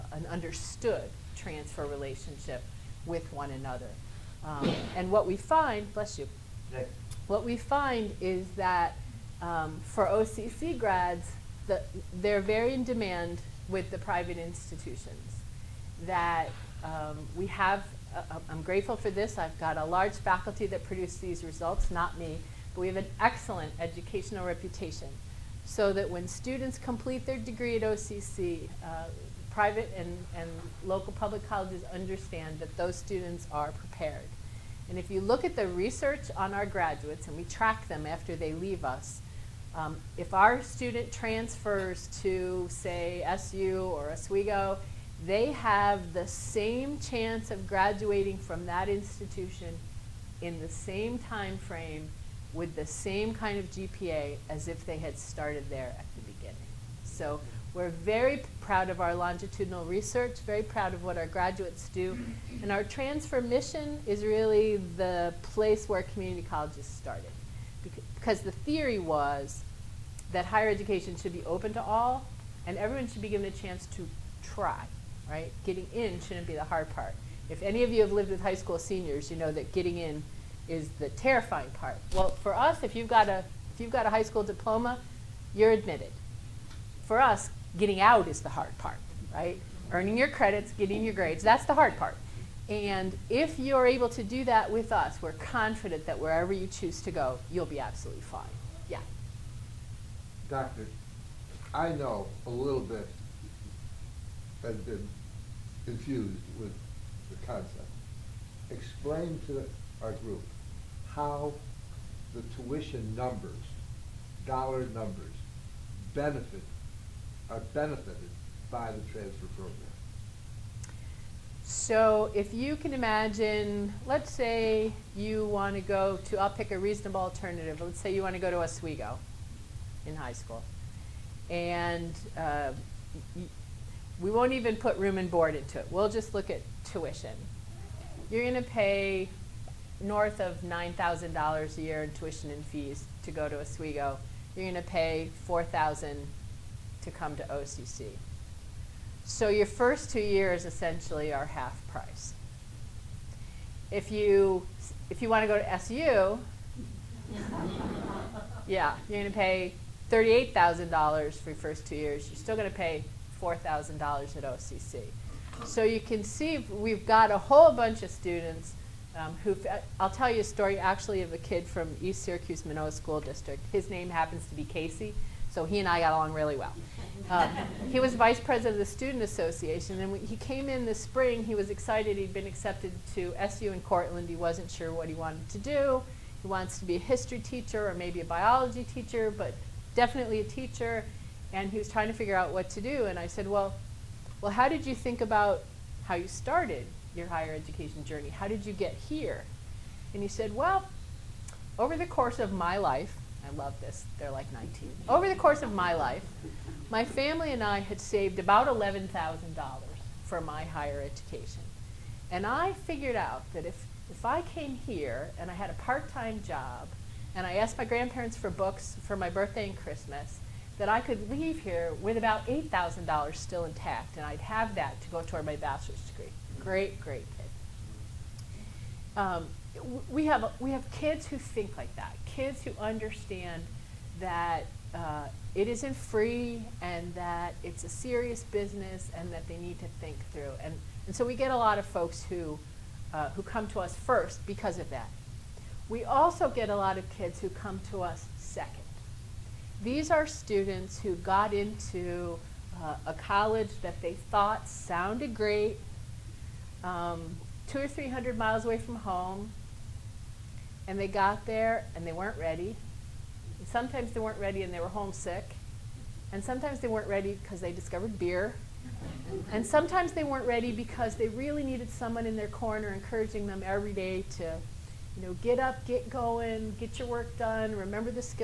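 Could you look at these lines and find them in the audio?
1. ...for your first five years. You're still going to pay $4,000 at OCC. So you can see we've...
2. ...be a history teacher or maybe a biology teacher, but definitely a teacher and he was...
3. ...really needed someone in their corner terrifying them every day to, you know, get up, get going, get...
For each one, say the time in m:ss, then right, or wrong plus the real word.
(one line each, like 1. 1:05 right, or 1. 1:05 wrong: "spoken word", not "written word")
1. 2:41 wrong: "two", not "five"
2. 3:06 right
3. 4:31 wrong: "encouraging", not "terrifying".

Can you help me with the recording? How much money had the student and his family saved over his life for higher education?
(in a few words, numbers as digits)
$11,000.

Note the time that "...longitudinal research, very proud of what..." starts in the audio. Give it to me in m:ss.
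0:59.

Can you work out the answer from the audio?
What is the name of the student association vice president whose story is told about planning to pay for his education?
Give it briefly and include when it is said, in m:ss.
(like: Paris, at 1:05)
Casey, at 2:54.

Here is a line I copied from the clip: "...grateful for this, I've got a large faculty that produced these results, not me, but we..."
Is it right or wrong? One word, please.
right.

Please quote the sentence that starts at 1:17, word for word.
If any of you have lived with high school seniors, you know that getting in is the terrifying part.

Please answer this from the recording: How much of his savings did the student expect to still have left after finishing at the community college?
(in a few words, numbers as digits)
$8,000.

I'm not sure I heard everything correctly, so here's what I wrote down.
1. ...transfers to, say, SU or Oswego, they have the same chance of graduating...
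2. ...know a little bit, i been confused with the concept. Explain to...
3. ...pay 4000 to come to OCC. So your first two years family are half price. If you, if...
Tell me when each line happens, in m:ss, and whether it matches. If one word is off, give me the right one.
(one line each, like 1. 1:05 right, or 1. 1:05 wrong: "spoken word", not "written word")
1. 0:41 right
2. 1:41 right
3. 2:24 wrong: "essentially", not "family".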